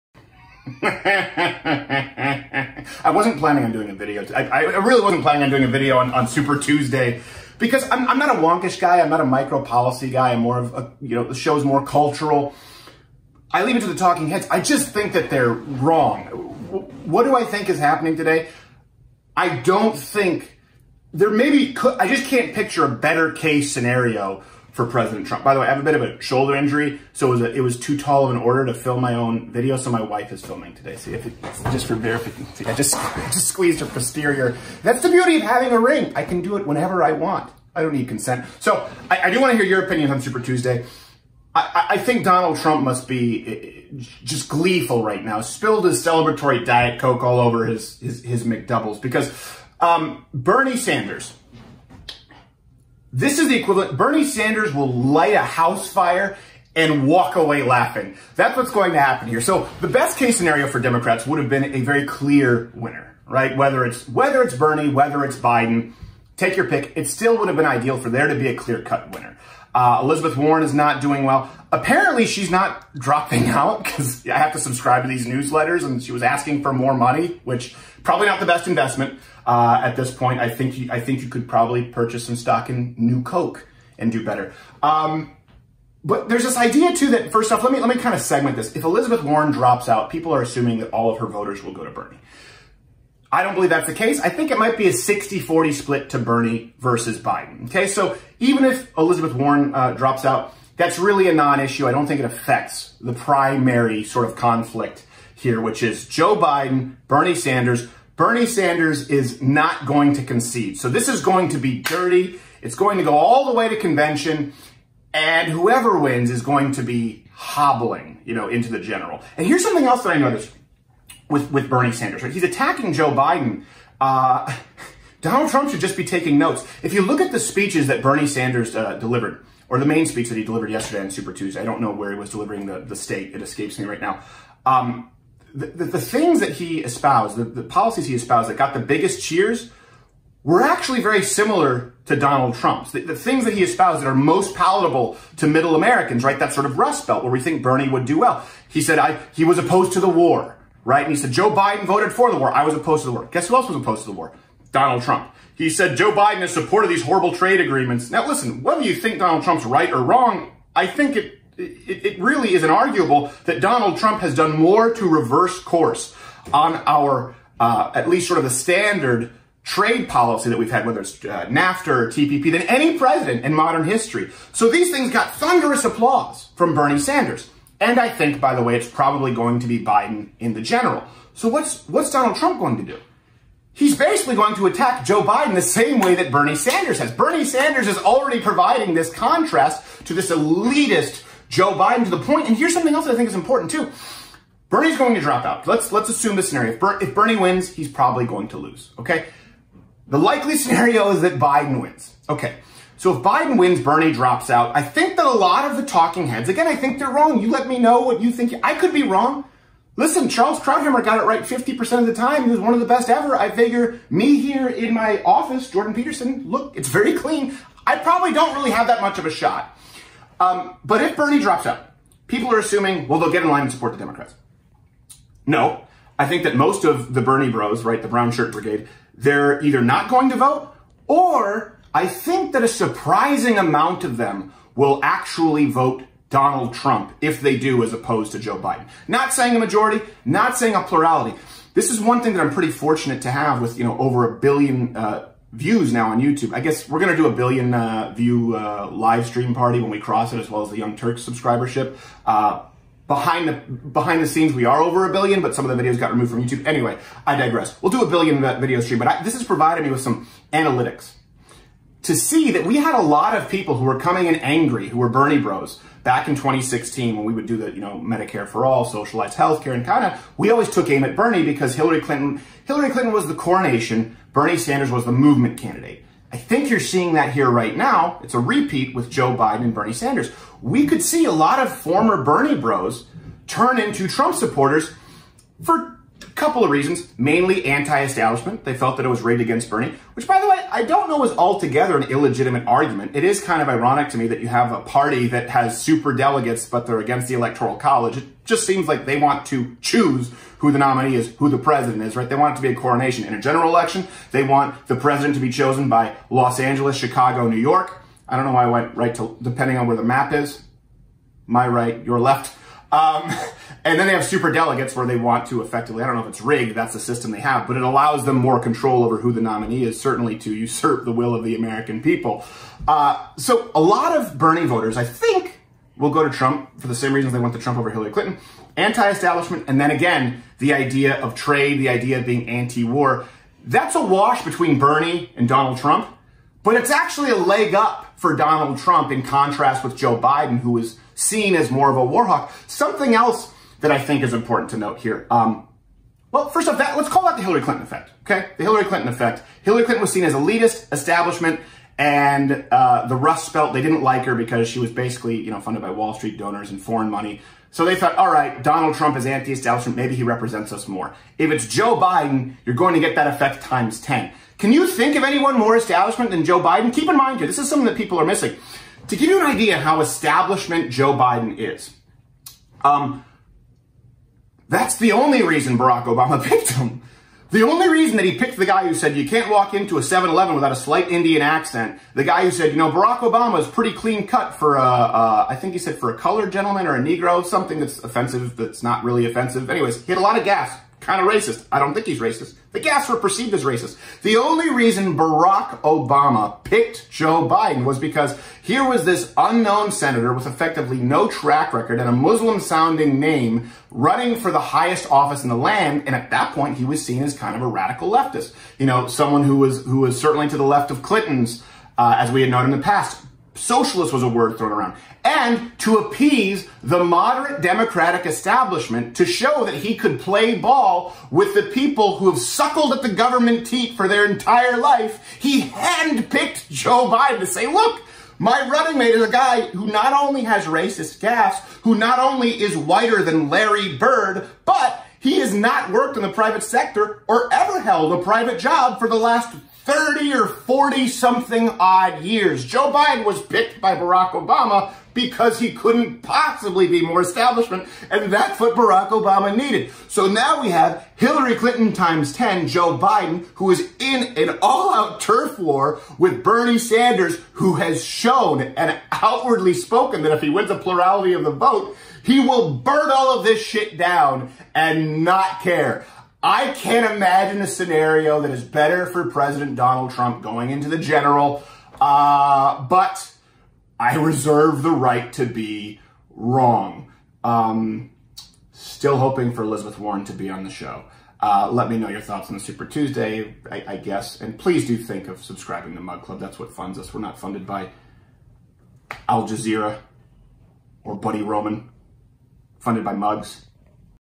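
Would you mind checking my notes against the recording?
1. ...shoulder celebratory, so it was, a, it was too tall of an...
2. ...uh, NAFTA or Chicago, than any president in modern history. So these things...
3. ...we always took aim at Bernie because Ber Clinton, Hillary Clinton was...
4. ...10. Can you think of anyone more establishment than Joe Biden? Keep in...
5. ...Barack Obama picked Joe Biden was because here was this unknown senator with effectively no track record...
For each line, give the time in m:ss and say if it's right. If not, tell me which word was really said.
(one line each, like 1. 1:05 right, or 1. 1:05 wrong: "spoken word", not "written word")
1. 0:26 wrong: "injury", not "celebratory"
2. 2:51 wrong: "TPP", not "Chicago"
3. 4:30 wrong: "Hillary", not "Ber"
4. 6:04 right
5. 6:35 right.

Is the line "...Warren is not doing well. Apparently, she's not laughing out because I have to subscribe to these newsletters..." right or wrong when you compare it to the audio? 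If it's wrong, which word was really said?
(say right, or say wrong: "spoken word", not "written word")
wrong: "dropping", not "laughing".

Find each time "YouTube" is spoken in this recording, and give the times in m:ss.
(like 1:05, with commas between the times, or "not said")
4:06, 4:16.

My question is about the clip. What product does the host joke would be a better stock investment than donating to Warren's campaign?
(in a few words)
New Coke.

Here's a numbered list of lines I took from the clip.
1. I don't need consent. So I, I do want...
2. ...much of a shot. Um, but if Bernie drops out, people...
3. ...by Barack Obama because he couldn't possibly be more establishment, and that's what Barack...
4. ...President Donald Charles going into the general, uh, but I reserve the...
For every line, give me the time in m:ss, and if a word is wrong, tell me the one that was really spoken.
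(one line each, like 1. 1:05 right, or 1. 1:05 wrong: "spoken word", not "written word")
1. 0:37 right
2. 3:39 right
3. 7:23 right
4. 7:49 wrong: "Trump", not "Charles".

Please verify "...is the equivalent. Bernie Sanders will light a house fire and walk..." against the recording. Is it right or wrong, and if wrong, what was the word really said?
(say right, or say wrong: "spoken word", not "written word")
right.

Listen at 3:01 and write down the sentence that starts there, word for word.
So what's, what's Donald Trump going to do?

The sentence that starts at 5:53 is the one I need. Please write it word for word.
They didn't like her because she was basically, you know, funded by Wall Street donors and foreign money.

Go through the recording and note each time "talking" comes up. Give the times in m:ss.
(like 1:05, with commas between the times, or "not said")
0:13, 3:25.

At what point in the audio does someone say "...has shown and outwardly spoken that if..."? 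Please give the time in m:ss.
7:37.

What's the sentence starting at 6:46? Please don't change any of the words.
And at that point, he was seen as kind of a radical leftist.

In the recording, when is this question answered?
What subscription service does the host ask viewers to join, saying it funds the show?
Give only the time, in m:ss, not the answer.
8:06.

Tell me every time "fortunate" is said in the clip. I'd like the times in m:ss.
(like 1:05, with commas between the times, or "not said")
4:02.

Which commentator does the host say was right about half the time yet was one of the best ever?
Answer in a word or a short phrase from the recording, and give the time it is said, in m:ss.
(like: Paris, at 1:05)
Charles Krauthammer, at 3:30.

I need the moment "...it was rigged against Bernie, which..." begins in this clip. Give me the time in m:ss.
4:49.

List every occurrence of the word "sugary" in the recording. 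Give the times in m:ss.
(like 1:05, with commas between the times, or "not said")
not said.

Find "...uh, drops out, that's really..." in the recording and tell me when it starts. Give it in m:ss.
1:39.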